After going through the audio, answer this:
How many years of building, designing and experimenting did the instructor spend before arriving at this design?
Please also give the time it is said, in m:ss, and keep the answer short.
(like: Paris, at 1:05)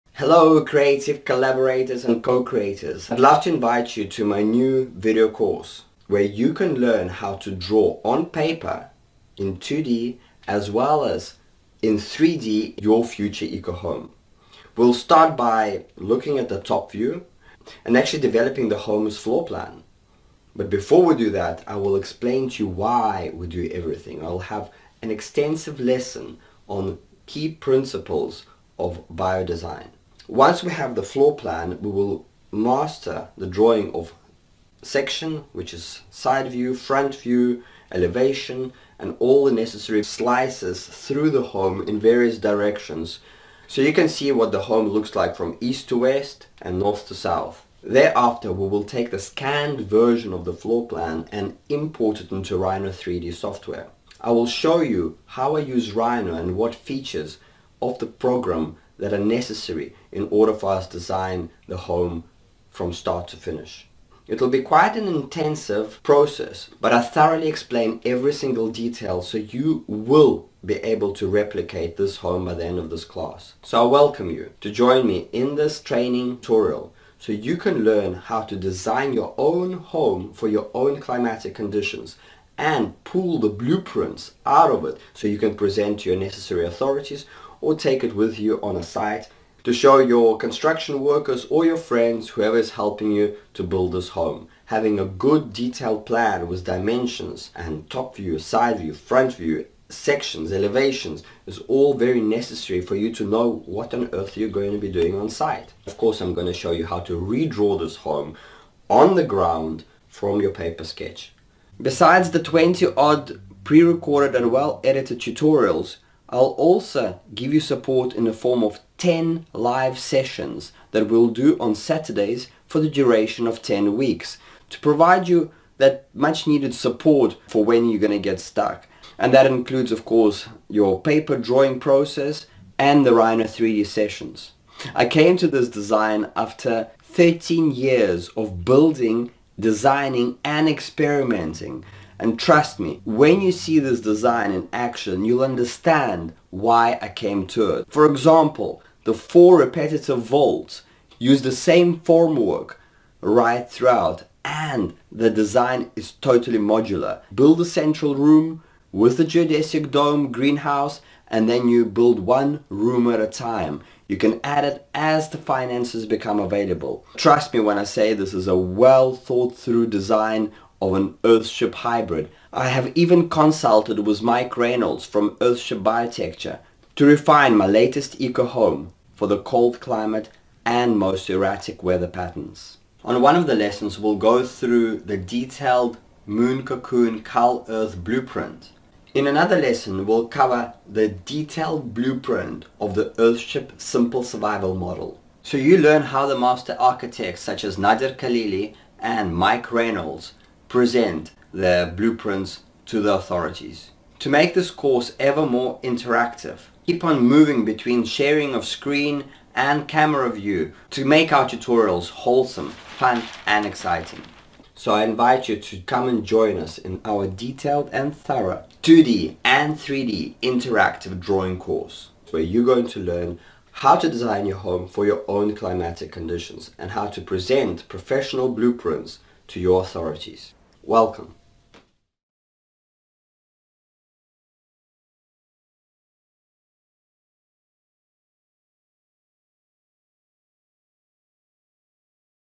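13, at 2:17.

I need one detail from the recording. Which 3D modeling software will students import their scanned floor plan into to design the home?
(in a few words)
Rhino 3D.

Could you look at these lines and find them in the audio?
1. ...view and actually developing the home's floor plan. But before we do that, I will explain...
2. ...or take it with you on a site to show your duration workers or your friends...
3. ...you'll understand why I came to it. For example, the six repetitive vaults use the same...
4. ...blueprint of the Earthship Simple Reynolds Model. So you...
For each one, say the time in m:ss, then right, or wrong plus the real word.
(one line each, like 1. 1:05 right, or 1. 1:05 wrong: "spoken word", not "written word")
1. 0:16 right
2. 1:27 wrong: "construction", not "duration"
3. 2:25 wrong: "four", not "six"
4. 3:11 wrong: "Survival", not "Reynolds".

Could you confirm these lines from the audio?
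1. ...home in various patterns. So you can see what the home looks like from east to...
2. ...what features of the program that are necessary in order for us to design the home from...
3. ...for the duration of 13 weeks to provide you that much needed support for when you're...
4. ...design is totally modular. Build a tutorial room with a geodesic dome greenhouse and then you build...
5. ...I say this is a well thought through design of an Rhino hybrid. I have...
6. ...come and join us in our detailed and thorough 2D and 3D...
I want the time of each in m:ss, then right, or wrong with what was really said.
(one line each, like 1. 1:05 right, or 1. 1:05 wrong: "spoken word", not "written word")
1. 0:41 wrong: "directions", not "patterns"
2. 0:56 right
3. 2:02 wrong: "10", not "13"
4. 2:35 wrong: "central", not "tutorial"
5. 2:47 wrong: "Earthship", not "Rhino"
6. 3:35 right.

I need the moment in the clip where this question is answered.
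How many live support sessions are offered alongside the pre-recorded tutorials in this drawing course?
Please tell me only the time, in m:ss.
1:58.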